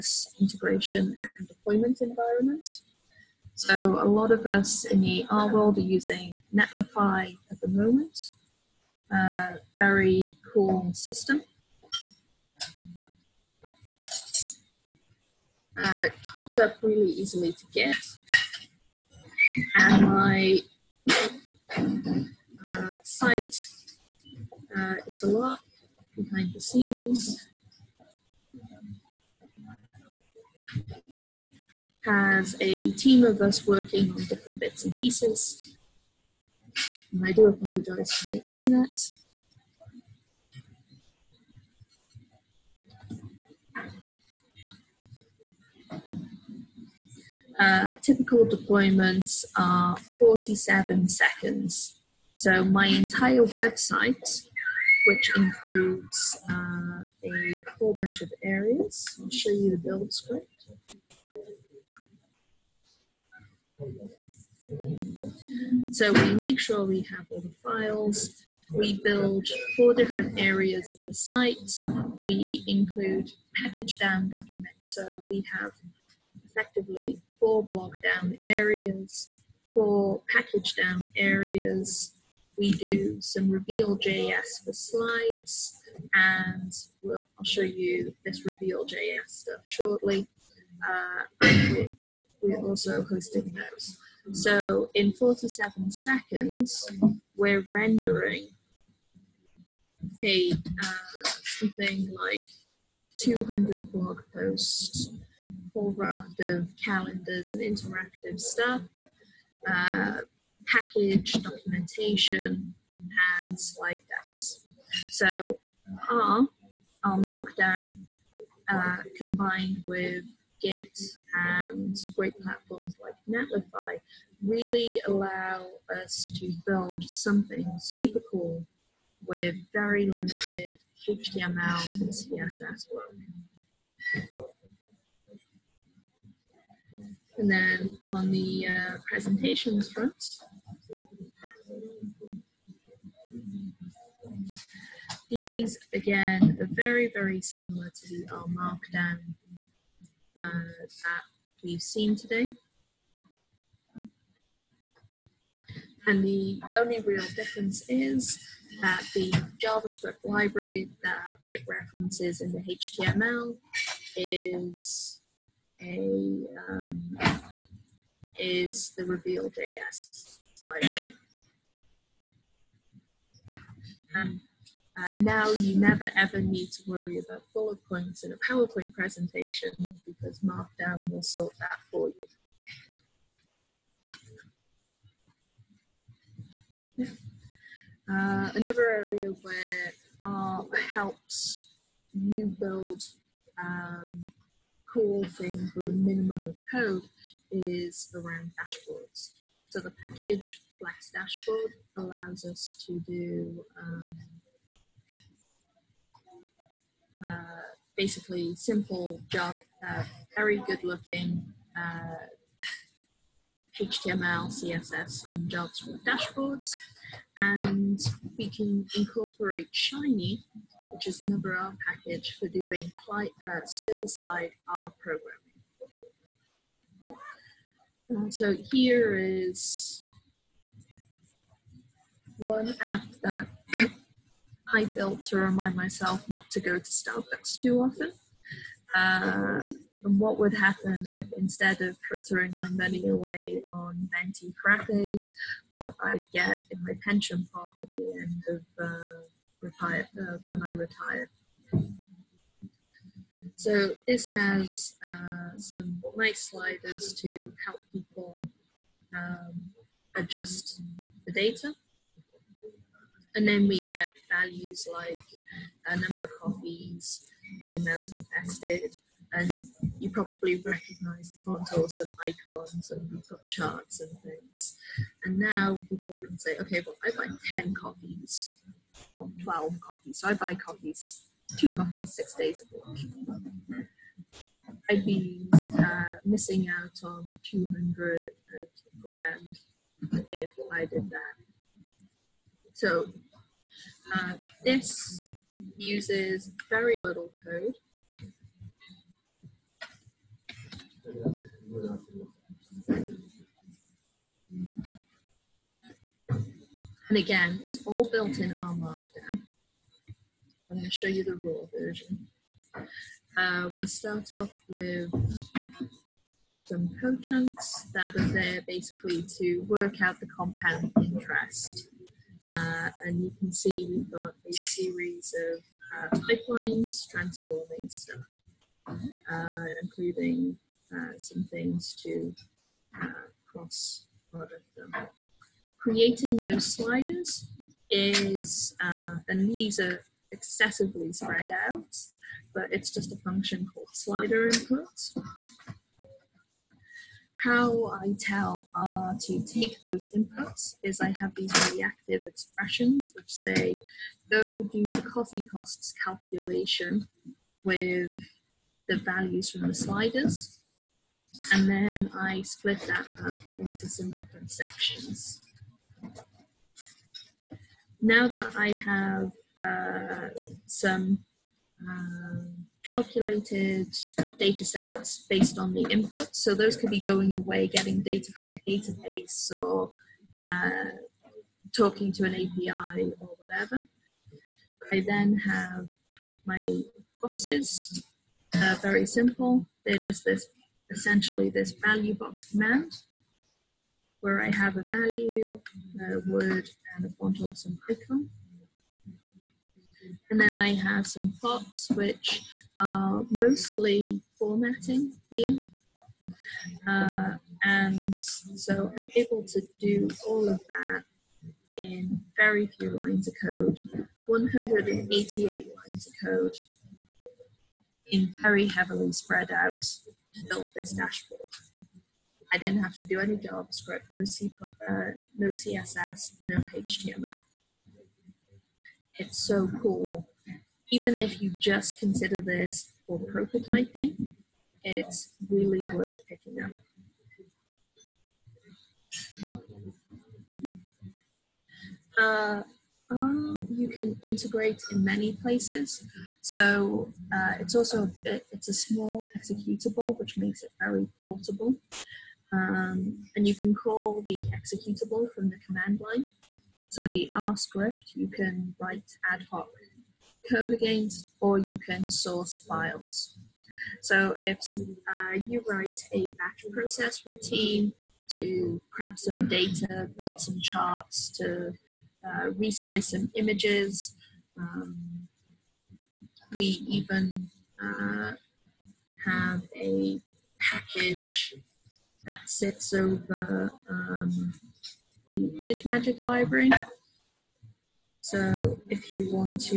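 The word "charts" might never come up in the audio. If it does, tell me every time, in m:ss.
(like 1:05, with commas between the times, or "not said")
4:33, 7:50.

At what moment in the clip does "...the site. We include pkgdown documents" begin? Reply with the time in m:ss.
1:11.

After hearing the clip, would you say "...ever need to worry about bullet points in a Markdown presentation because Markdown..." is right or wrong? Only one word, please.
wrong.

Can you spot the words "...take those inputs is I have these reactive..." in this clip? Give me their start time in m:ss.
5:49.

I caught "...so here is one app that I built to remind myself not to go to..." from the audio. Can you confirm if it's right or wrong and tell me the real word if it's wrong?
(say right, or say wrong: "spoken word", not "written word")
right.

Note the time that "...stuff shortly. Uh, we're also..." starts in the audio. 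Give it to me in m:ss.
1:29.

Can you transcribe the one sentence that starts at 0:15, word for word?
Uh, it hooks up really easily to Git.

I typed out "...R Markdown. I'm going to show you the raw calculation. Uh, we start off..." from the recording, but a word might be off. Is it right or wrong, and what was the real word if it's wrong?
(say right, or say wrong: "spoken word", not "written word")
wrong: "version", not "calculation".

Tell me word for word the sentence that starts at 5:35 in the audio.
Creating those sliders is, uh, and these are excessively spread out, but it's just a function called slider input.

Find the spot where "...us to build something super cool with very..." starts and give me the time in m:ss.
2:06.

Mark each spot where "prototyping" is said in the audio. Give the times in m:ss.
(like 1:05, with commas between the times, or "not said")
7:13.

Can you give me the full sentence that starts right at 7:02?
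I didn't have to do any JavaScript, no, C, uh, no CSS, no HTML.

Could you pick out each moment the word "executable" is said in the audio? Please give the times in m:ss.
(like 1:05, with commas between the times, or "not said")
7:29, 7:34.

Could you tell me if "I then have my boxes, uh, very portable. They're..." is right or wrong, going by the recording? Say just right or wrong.
wrong.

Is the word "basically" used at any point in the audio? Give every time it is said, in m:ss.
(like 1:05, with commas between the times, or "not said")
3:27, 5:18.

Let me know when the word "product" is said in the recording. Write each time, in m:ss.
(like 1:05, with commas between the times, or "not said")
5:34.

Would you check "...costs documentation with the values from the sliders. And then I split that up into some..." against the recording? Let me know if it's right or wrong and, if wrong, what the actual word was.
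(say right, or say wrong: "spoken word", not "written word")
wrong: "calculation", not "documentation".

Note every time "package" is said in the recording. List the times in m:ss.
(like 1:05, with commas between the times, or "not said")
1:50, 3:20, 3:41, 8:00.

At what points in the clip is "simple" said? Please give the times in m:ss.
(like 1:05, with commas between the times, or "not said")
3:28, 6:29.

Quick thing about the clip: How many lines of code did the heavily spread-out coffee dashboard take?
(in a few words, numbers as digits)
188.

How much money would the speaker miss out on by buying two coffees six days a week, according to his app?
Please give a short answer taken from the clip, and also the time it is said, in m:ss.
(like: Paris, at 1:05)
200 grand, at 4:47.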